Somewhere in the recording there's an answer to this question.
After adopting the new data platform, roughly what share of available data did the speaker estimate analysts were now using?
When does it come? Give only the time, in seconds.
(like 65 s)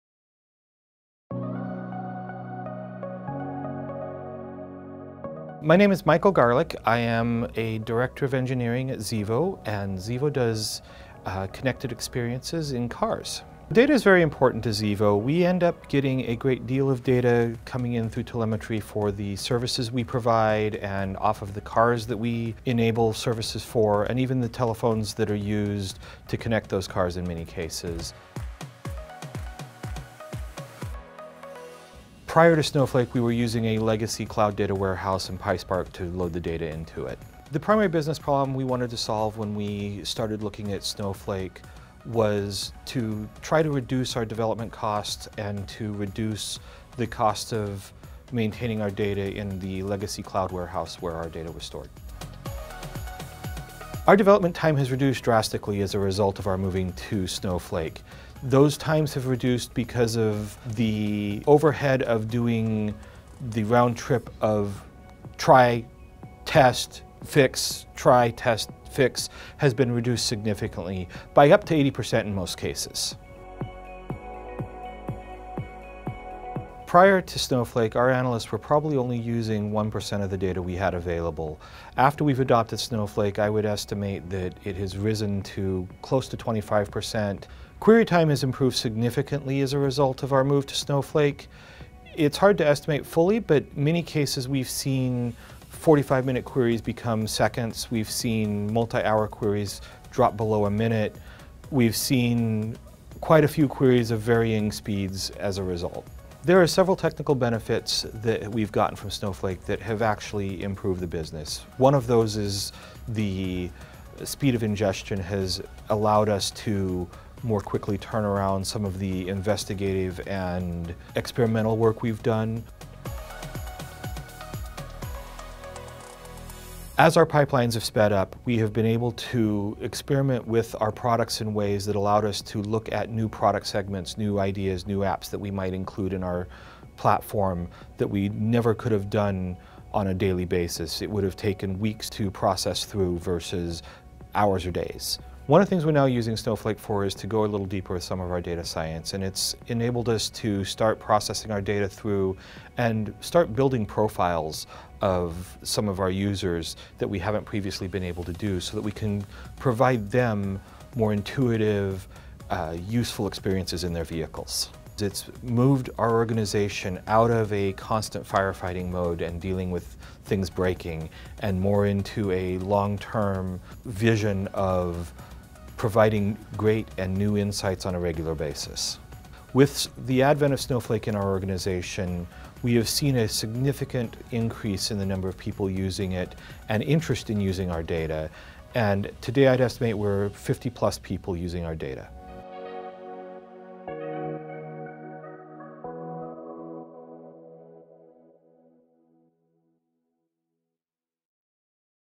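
86 s.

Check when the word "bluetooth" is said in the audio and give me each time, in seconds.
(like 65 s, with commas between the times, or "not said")
not said.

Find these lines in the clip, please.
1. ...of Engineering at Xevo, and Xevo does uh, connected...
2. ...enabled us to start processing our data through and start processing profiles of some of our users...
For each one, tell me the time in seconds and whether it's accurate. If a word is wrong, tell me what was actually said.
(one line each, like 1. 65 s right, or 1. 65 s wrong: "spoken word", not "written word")
1. 8 s right
2. 149 s wrong: "building", not "processing".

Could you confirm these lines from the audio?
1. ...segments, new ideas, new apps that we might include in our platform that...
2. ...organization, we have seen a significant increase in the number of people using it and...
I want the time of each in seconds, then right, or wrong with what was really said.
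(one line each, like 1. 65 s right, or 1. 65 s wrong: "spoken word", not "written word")
1. 133 s right
2. 181 s right.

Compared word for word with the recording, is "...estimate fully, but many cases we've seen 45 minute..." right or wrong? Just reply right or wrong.
right.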